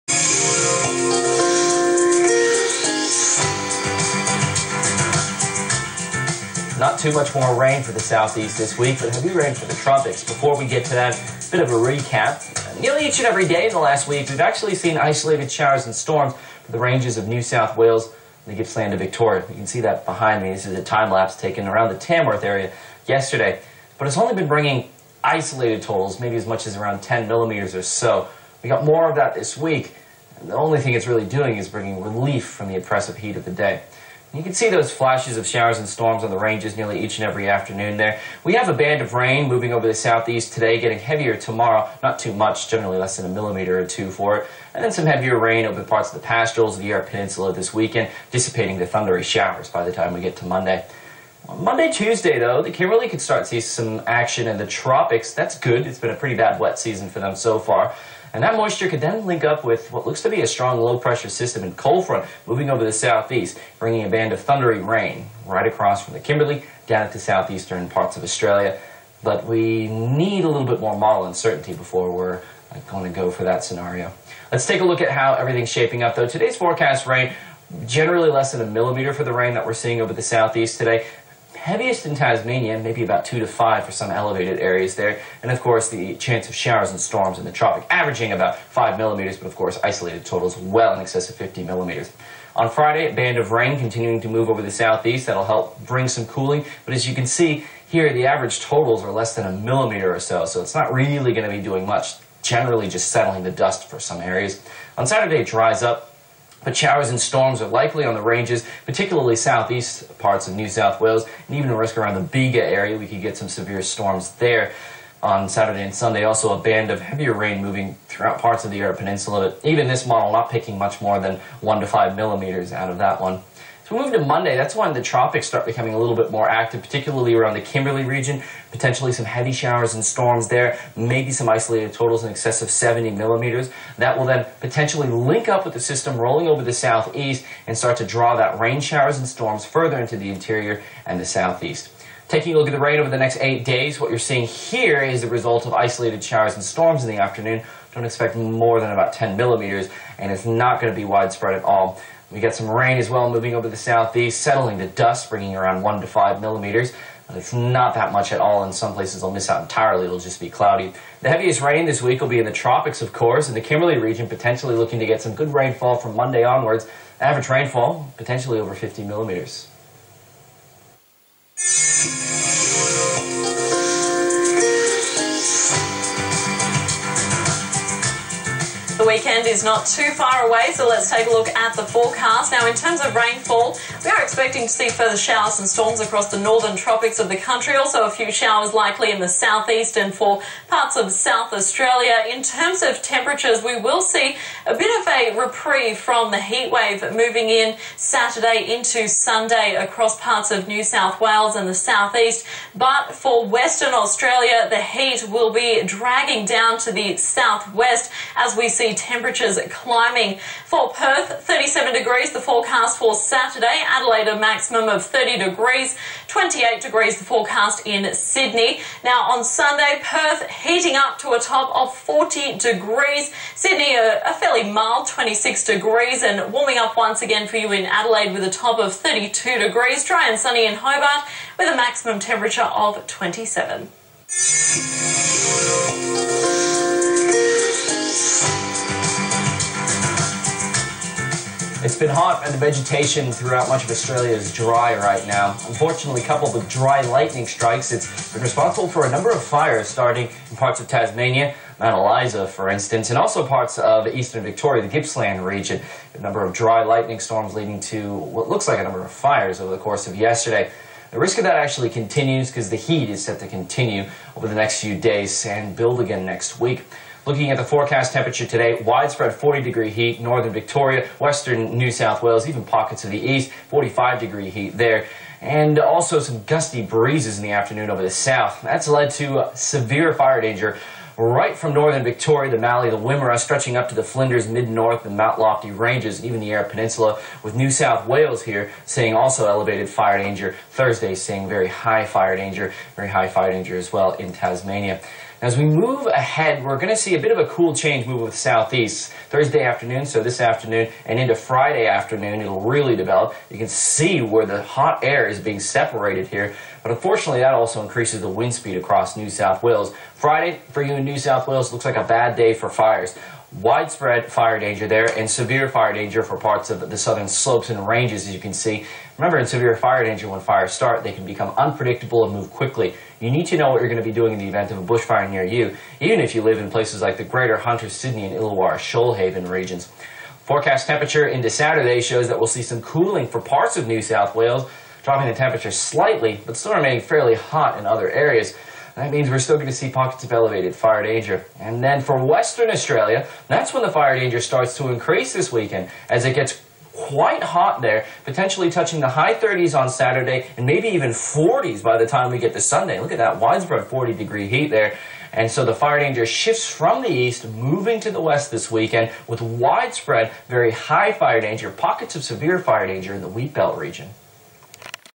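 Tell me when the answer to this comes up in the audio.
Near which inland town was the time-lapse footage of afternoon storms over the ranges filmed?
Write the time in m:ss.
0:21.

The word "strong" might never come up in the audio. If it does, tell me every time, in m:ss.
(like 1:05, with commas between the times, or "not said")
1:00.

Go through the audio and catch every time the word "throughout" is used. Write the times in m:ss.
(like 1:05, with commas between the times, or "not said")
1:58, 4:03.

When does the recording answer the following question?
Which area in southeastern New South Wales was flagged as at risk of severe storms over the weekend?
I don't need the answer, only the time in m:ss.
1:52.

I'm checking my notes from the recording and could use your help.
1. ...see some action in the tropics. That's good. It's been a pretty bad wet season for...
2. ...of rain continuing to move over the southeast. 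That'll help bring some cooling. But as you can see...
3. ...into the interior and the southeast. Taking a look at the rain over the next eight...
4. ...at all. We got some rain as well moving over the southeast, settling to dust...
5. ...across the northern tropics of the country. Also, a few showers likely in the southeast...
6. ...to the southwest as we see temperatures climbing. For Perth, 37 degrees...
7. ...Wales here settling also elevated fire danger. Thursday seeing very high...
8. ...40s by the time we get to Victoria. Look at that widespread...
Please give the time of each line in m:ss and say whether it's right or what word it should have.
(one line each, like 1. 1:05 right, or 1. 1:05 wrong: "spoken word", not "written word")
1. 0:53 right
2. 1:33 right
3. 2:19 right
4. 2:31 right
5. 3:05 right
6. 3:26 right
7. 4:48 wrong: "seeing", not "settling"
8. 5:51 wrong: "Sunday", not "Victoria".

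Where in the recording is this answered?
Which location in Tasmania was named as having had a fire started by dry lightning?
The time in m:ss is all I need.
4:11.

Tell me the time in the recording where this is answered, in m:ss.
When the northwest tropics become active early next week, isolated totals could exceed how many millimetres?
2:12.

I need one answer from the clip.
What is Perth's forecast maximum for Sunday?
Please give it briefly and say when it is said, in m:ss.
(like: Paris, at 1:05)
40 degrees, at 3:41.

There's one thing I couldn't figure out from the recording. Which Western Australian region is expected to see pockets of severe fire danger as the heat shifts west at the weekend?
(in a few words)
Wheat Belt.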